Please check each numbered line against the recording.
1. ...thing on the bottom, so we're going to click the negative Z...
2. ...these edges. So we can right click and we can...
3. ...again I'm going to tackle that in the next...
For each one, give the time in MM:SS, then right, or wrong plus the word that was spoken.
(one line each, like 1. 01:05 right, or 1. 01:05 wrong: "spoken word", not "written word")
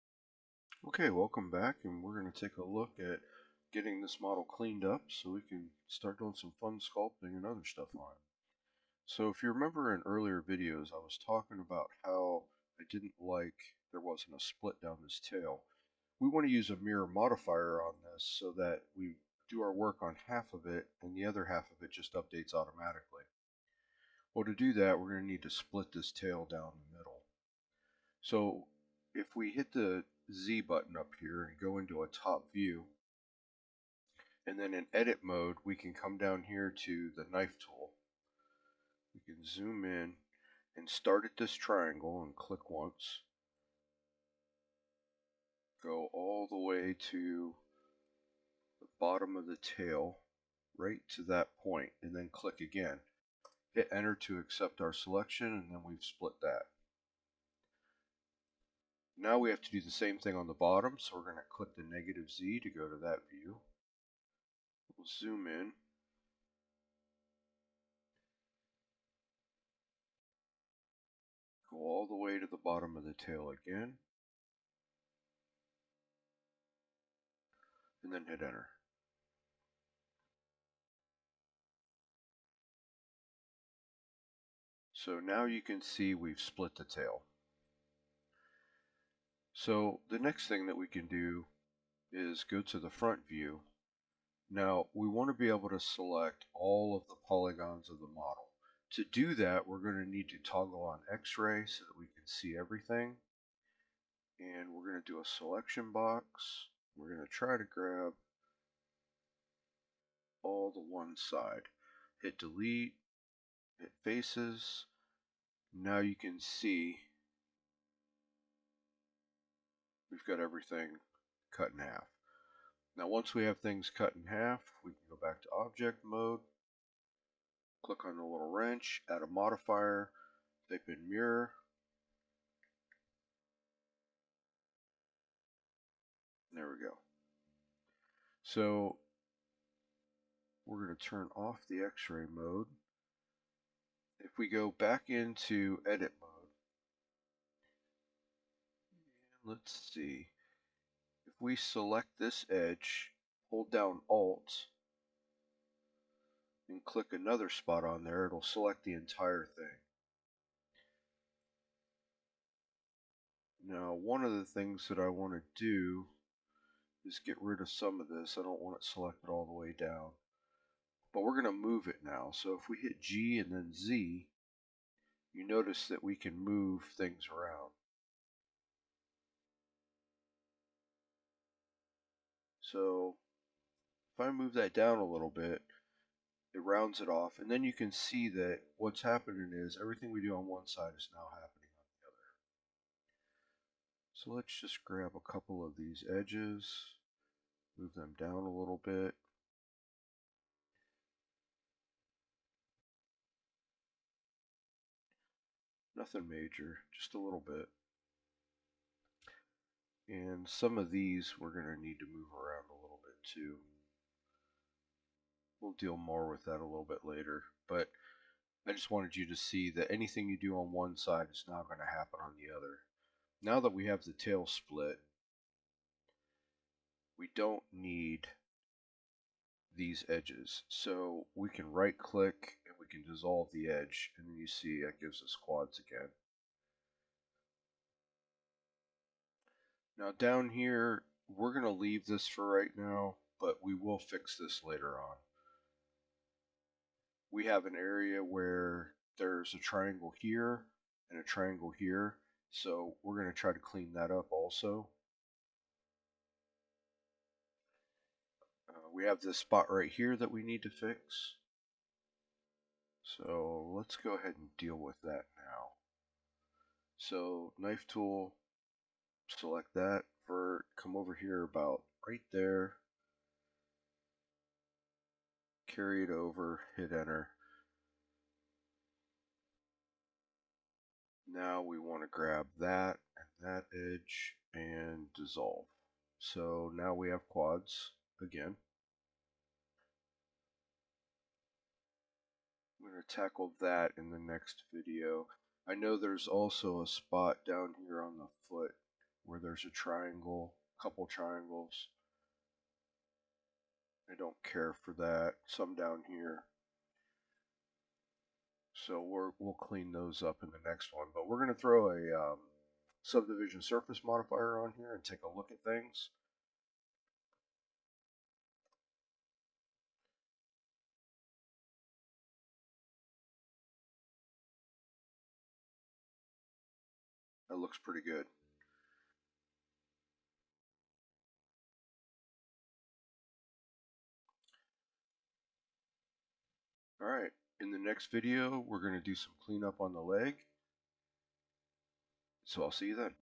1. 01:00 right
2. 03:49 right
3. 04:48 right.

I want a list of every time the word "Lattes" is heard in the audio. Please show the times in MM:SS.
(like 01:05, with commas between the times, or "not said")
not said.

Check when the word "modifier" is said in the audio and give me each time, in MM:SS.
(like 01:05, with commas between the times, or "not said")
00:17, 02:09, 05:14.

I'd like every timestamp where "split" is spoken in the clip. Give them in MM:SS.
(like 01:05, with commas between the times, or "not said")
00:14, 00:25, 00:56, 01:26, 03:44.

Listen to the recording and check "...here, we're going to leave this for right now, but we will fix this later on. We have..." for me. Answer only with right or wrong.
right.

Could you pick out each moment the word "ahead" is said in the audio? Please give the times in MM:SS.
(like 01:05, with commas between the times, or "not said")
04:24.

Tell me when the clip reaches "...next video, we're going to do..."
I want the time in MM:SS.
05:37.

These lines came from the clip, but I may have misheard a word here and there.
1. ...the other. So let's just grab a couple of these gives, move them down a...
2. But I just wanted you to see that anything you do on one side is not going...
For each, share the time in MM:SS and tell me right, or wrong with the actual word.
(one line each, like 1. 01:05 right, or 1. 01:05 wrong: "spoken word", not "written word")
1. 03:11 wrong: "edges", not "gives"
2. 03:37 right.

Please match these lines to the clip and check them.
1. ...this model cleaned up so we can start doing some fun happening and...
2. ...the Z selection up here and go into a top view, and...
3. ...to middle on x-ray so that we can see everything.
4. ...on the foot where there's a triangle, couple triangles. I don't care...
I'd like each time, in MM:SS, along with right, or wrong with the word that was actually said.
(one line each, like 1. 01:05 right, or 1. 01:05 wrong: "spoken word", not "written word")
1. 00:04 wrong: "sculpting", not "happening"
2. 00:29 wrong: "button", not "selection"
3. 01:40 wrong: "toggle", not "middle"
4. 04:58 right.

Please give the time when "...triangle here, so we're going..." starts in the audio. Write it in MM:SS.
04:11.